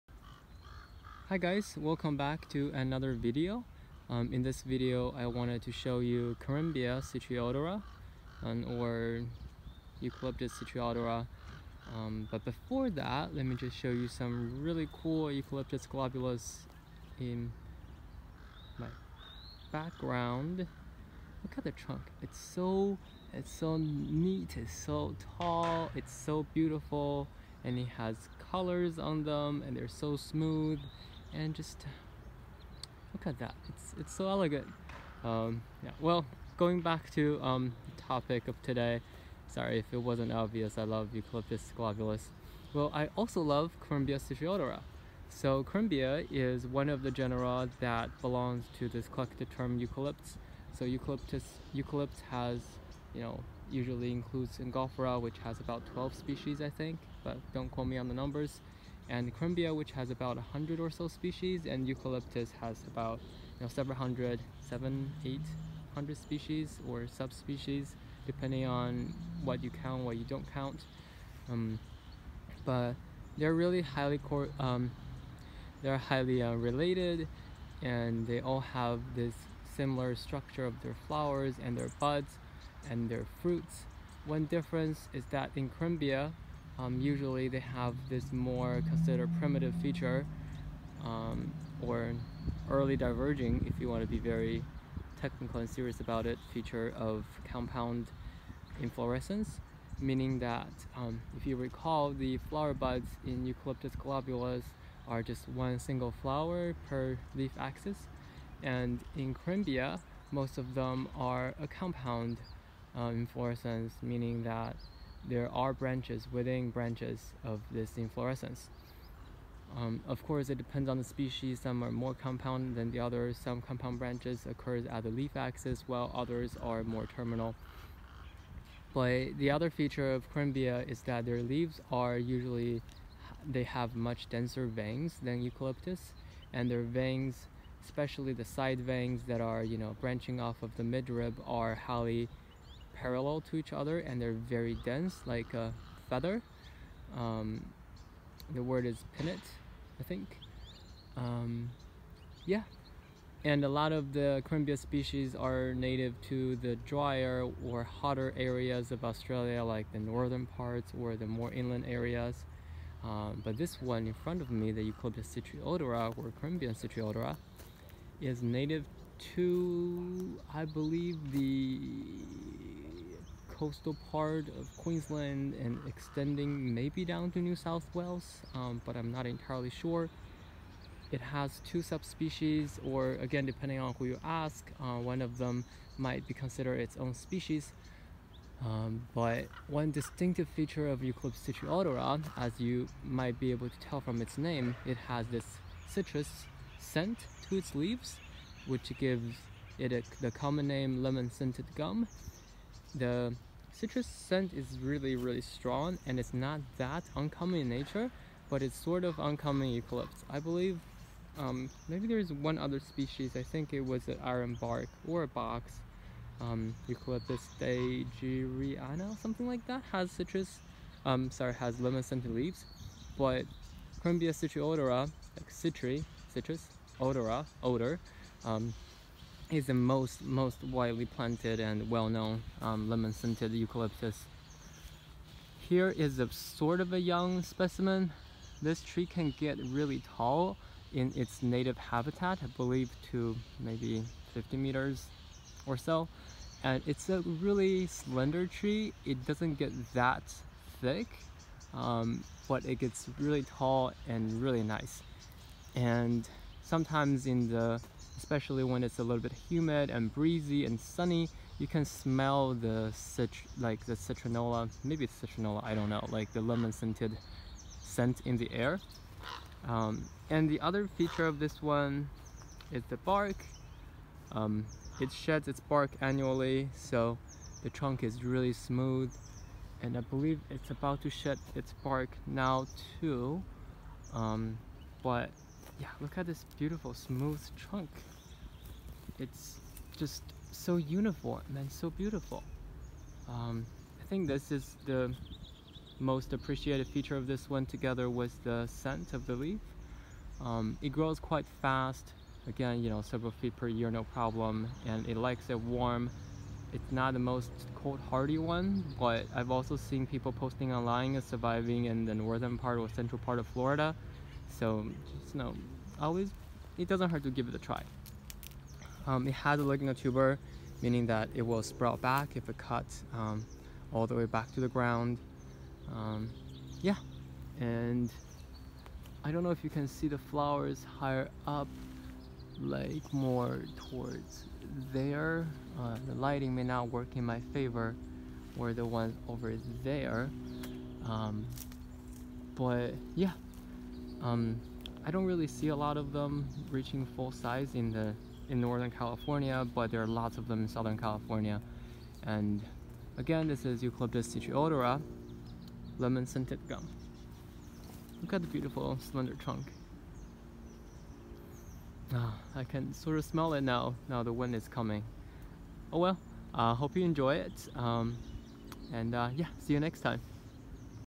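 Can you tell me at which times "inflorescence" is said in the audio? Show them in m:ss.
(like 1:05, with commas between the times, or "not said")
1:38, 1:53, 1:57.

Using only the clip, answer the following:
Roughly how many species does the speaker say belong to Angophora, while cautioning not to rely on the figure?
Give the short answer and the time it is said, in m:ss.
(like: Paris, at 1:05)
12, at 0:55.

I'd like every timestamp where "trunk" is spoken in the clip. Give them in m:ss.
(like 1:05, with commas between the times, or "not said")
0:21, 4:37, 4:47, 5:59.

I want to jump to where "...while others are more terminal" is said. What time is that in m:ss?
2:05.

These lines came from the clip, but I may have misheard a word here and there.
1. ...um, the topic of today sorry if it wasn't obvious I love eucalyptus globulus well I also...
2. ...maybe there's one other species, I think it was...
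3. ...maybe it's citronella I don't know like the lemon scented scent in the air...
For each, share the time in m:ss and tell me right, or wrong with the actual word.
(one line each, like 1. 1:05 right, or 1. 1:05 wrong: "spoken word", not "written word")
1. 0:37 right
2. 3:31 right
3. 4:24 right.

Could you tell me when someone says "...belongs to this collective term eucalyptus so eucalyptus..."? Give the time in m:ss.
0:48.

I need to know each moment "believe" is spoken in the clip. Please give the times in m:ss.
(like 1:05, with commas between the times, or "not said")
2:50, 3:30, 4:02, 4:40.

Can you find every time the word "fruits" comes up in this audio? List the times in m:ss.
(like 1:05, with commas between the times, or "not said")
1:23.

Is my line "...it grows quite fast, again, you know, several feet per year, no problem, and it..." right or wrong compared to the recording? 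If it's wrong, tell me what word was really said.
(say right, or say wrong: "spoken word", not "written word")
right.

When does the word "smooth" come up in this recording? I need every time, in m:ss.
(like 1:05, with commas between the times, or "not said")
0:30, 4:38, 4:46.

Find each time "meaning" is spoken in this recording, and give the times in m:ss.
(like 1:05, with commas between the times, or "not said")
1:39, 1:54, 5:20.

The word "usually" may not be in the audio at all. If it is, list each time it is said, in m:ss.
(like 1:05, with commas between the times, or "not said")
0:53, 1:26, 2:12.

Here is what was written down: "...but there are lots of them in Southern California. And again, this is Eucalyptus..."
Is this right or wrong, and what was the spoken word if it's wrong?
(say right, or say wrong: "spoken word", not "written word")
right.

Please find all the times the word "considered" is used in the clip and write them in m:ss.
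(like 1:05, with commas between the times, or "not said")
1:28, 3:06.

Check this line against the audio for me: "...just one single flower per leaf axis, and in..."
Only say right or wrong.
right.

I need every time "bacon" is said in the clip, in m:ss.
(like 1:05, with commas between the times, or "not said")
not said.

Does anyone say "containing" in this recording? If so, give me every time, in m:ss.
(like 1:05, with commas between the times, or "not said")
not said.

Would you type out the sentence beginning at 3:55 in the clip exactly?
Here is a sort of a young specimen.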